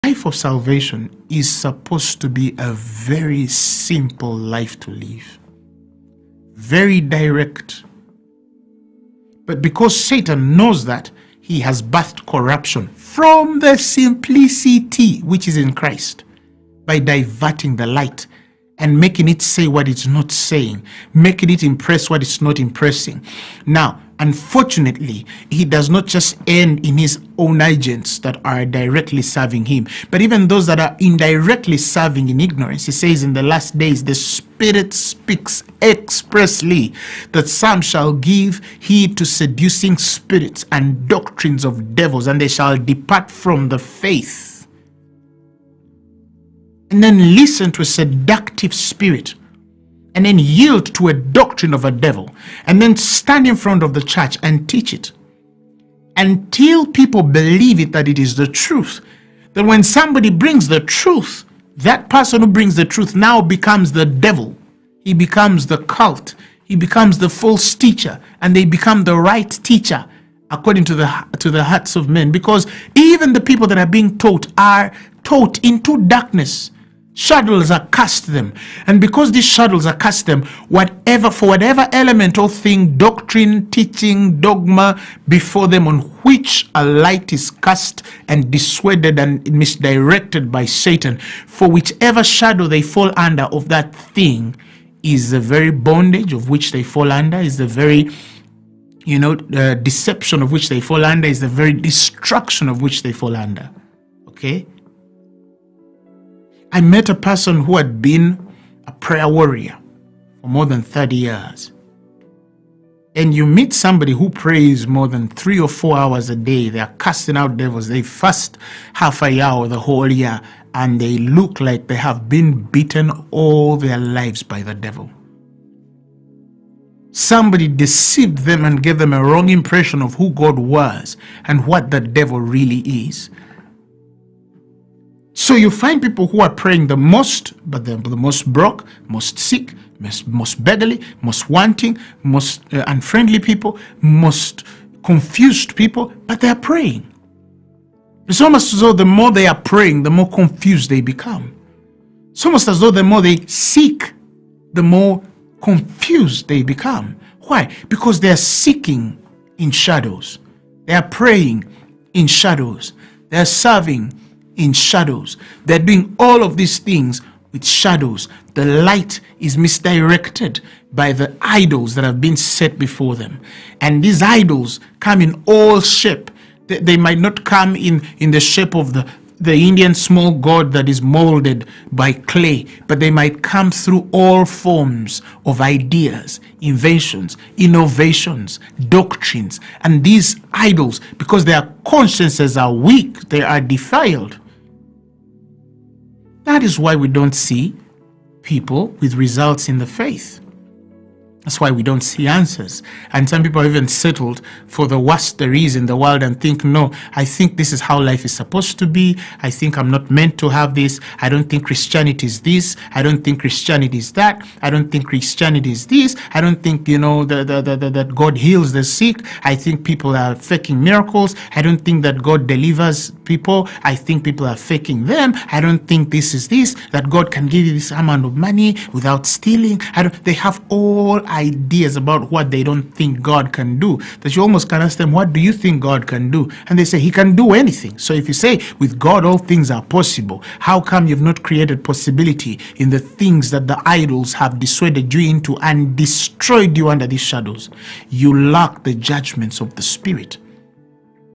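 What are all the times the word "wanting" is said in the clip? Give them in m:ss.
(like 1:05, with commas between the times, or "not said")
2:21.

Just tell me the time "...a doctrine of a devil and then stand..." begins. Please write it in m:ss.
0:51.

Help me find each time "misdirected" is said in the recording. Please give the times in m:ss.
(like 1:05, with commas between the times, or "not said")
1:29, 2:49.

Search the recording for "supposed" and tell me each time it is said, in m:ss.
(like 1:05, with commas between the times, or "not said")
0:01, 3:28.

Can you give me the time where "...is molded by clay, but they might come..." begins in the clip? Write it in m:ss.
3:00.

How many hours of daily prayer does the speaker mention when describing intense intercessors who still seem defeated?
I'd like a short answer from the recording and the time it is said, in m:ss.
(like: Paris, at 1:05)
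three or four hours, at 1:55.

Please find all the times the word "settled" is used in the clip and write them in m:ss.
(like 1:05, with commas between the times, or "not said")
3:23.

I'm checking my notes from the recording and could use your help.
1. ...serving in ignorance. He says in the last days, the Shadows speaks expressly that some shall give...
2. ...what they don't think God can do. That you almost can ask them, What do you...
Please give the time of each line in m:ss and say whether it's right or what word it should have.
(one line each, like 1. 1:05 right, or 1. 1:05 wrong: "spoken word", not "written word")
1. 0:31 wrong: "Spirit", not "Shadows"
2. 3:52 right.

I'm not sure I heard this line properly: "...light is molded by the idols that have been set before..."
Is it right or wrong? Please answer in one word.
wrong.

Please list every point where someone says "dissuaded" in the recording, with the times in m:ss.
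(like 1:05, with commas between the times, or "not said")
1:28, 4:04.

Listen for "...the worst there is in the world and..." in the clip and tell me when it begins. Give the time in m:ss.
3:24.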